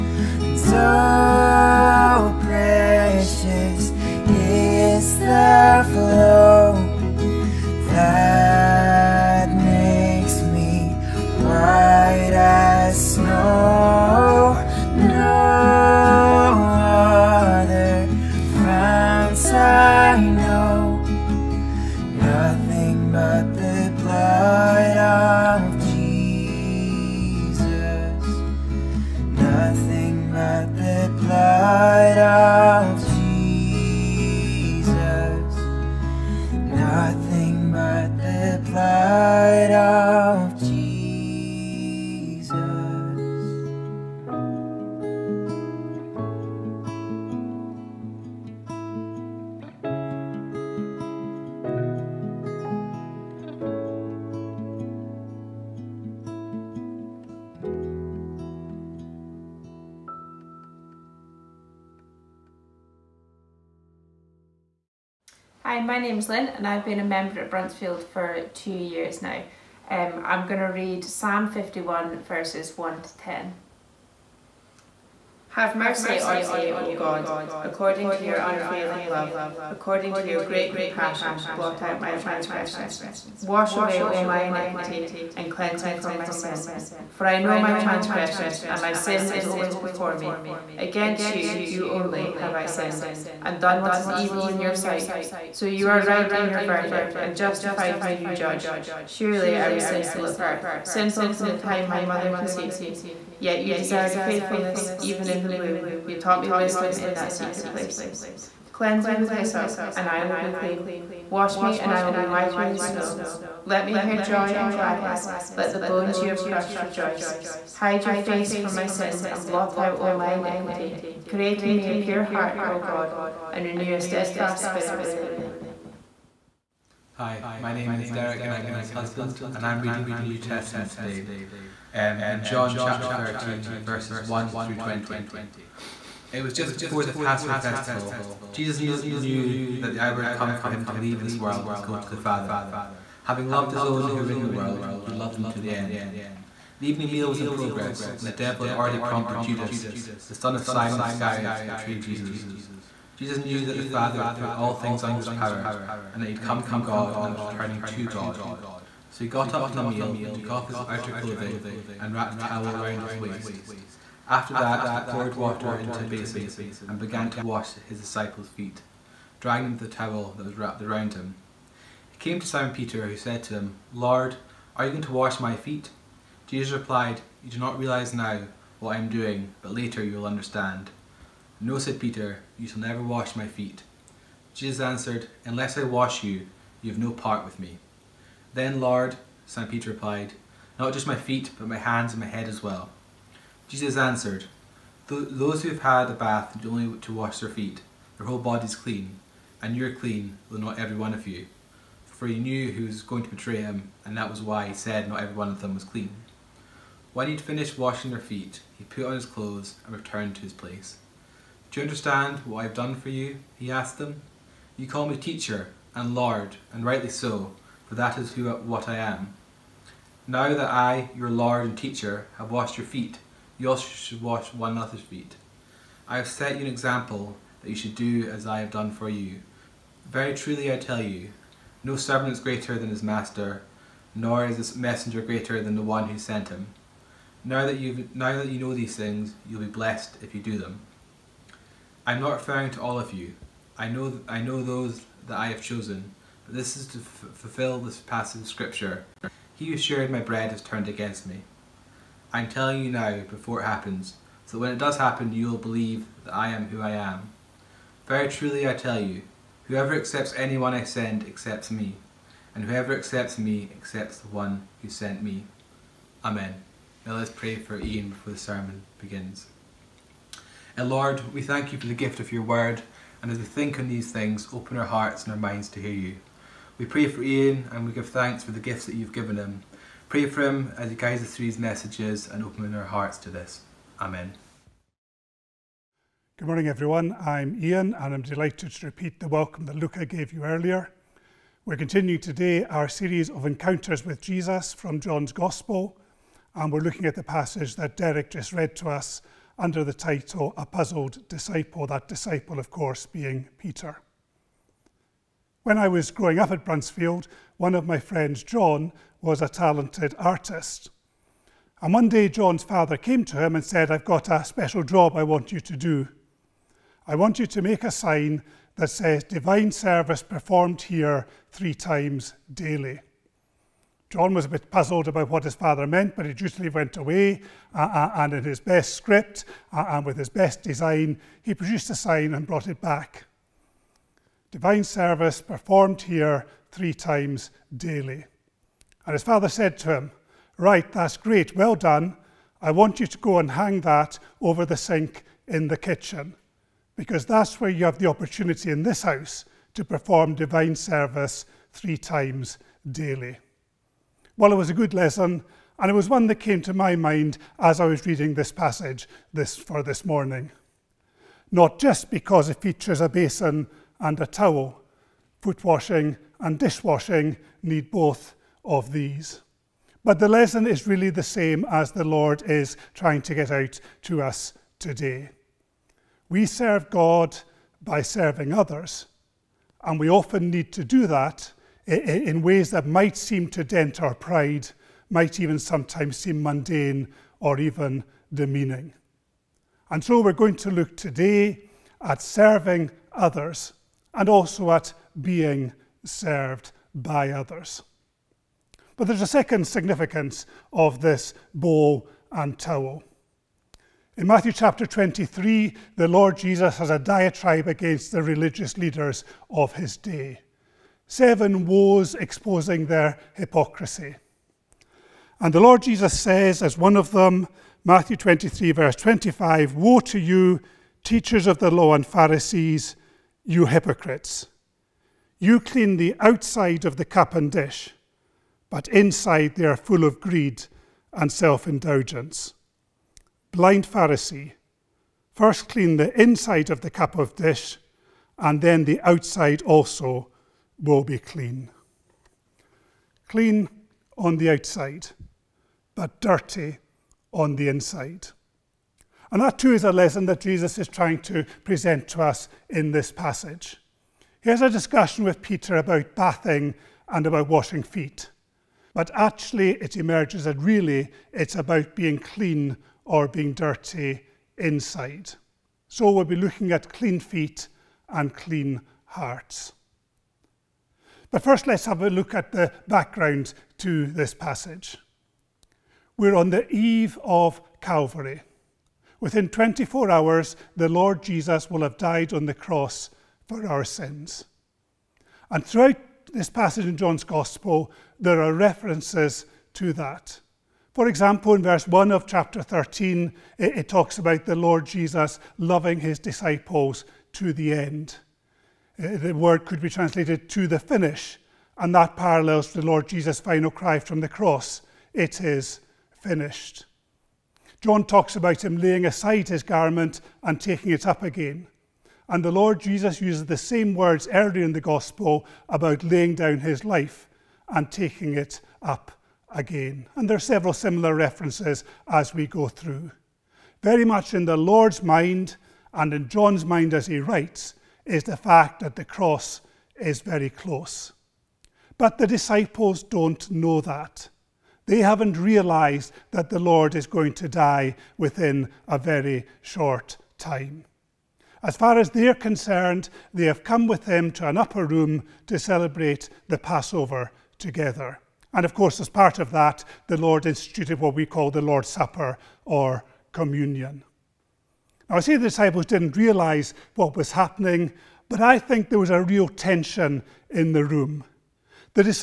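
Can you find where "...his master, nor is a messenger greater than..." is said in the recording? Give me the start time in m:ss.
3:52.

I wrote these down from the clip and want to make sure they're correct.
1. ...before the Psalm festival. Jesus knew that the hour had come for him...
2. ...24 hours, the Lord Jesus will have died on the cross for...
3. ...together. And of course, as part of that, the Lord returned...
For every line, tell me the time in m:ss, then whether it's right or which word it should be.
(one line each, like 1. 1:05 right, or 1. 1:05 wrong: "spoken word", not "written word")
1. 2:16 wrong: "Passover", not "Psalm"
2. 7:59 right
3. 9:07 wrong: "instituted", not "returned".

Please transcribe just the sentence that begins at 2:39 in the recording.
So he got up from the meal, took off his outer clothing, and wrapped a towel around his waist.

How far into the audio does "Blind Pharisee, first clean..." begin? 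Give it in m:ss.
7:13.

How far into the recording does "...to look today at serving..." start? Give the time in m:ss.
6:30.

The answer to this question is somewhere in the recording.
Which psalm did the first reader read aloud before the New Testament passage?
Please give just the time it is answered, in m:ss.
1:11.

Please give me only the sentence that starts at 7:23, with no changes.
Clean on the outside, but dirty on the inside.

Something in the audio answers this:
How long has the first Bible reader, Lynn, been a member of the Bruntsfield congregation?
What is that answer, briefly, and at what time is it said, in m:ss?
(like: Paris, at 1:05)
2 years, at 1:08.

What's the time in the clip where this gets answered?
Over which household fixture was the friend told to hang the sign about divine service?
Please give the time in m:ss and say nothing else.
5:44.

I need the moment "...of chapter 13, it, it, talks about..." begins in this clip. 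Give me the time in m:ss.
8:12.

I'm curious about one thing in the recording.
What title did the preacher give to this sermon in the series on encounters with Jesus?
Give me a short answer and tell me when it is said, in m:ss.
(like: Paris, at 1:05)
A Puzzled Disciple, at 5:00.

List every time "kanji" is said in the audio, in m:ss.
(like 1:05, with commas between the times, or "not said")
not said.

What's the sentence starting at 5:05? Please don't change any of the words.
When I was growing up at Bruntsfield, one of my friends, John, was a talented artist.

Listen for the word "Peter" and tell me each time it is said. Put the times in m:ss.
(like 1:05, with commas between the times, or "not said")
2:52, 3:01, 3:09, 5:03, 7:35.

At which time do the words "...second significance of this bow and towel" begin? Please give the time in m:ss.
6:39.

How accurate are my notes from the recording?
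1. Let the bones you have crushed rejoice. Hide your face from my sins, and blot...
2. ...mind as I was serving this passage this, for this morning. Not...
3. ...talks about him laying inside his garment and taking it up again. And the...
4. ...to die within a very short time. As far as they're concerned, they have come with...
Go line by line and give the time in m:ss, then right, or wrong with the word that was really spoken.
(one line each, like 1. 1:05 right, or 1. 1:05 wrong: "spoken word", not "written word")
1. 1:55 right
2. 5:56 wrong: "reading", not "serving"
3. 8:28 wrong: "aside", not "inside"
4. 8:57 right.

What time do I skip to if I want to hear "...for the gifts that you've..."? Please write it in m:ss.
4:38.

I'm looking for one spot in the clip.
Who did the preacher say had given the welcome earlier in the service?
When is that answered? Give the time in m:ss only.
4:49.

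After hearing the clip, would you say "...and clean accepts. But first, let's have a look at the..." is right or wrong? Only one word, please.
wrong.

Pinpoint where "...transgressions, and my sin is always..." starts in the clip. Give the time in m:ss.
1:27.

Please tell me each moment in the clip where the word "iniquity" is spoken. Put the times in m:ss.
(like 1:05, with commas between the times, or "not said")
1:24, 2:00.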